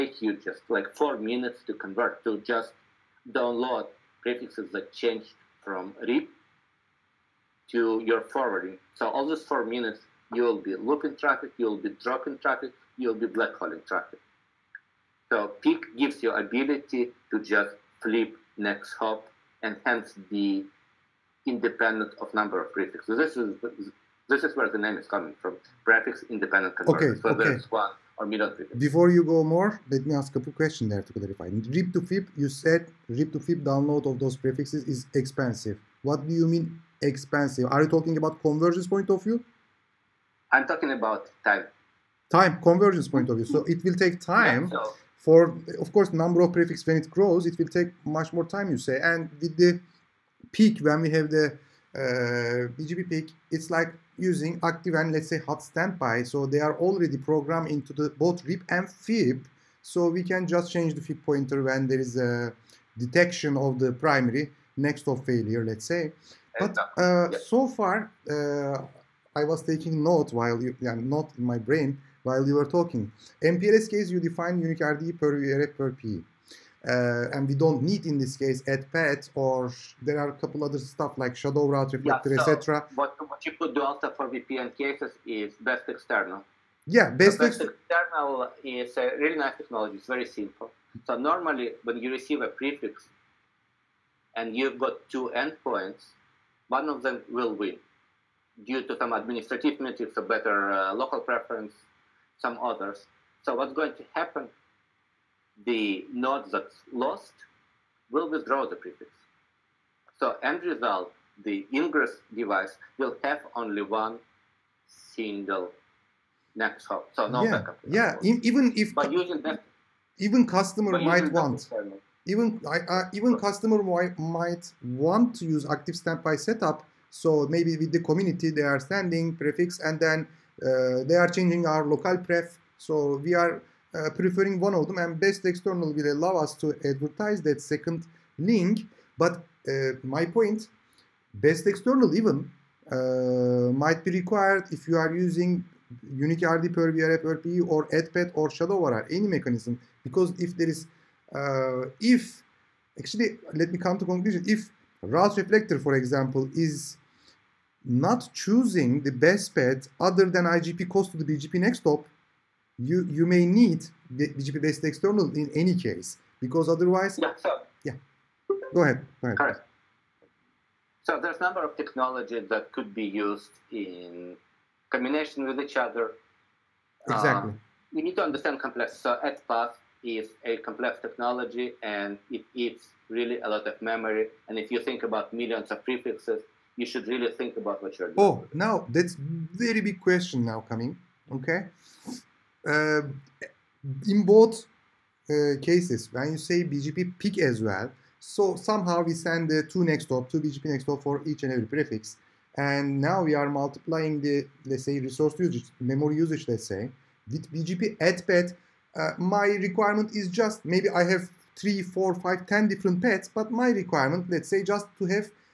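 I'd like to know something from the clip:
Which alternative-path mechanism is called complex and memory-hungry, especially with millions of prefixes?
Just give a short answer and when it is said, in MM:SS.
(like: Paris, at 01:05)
XPath, at 02:59.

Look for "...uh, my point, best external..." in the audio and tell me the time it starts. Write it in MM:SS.
02:19.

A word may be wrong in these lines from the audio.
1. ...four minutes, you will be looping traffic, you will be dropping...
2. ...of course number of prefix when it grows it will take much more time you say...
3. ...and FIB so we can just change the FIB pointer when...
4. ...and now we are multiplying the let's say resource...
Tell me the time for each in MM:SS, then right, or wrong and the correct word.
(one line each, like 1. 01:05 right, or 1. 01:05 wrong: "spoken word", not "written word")
1. 00:09 right
2. 00:45 right
3. 00:58 right
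4. 03:22 right.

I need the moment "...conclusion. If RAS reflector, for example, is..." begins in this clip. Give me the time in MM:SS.
02:34.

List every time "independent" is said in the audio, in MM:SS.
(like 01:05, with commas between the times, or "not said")
00:21, 00:26.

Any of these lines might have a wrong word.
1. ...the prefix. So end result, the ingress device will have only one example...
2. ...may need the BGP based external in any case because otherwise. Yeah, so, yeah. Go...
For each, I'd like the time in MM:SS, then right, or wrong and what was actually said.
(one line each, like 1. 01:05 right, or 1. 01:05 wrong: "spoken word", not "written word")
1. 01:48 wrong: "single", not "example"
2. 02:43 right.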